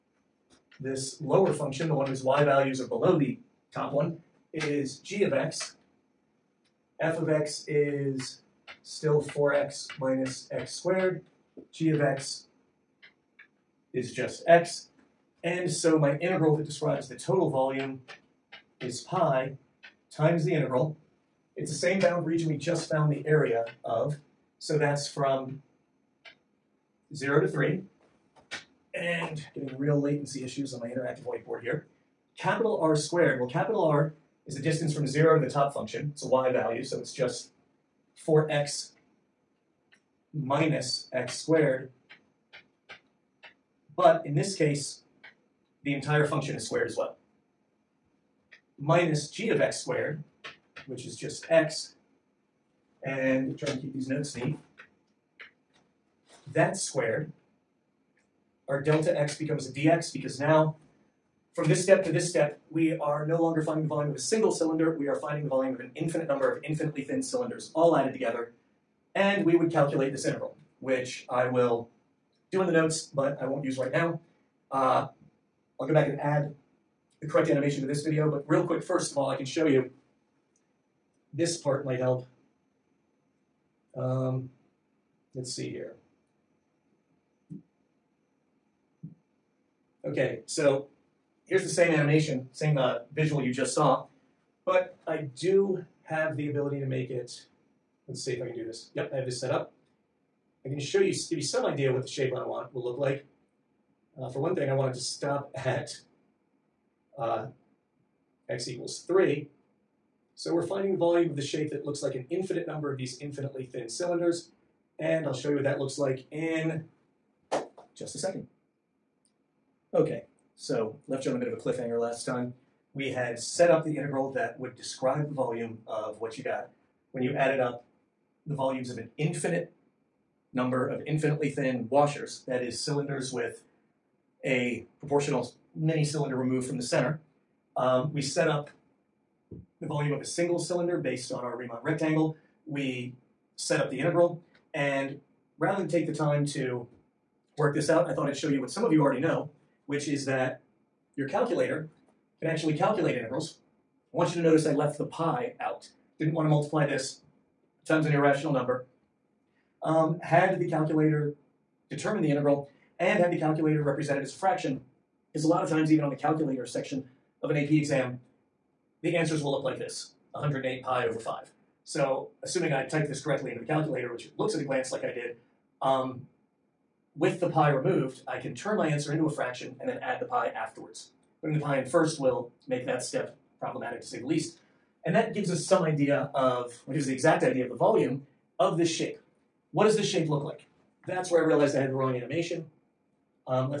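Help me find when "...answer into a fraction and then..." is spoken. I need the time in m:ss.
2:58.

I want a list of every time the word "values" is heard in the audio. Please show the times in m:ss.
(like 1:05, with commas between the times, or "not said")
0:02, 0:36.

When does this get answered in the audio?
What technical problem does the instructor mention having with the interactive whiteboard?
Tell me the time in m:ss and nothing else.
0:30.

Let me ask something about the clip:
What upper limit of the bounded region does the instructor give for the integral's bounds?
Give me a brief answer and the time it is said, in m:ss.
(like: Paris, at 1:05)
3, at 0:25.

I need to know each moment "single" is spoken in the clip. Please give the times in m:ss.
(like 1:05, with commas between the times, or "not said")
1:04, 2:20.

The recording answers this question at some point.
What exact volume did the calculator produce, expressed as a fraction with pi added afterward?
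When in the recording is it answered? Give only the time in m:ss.
2:50.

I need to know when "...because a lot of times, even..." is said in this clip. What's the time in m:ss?
2:45.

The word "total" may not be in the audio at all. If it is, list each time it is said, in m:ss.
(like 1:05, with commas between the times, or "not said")
0:17.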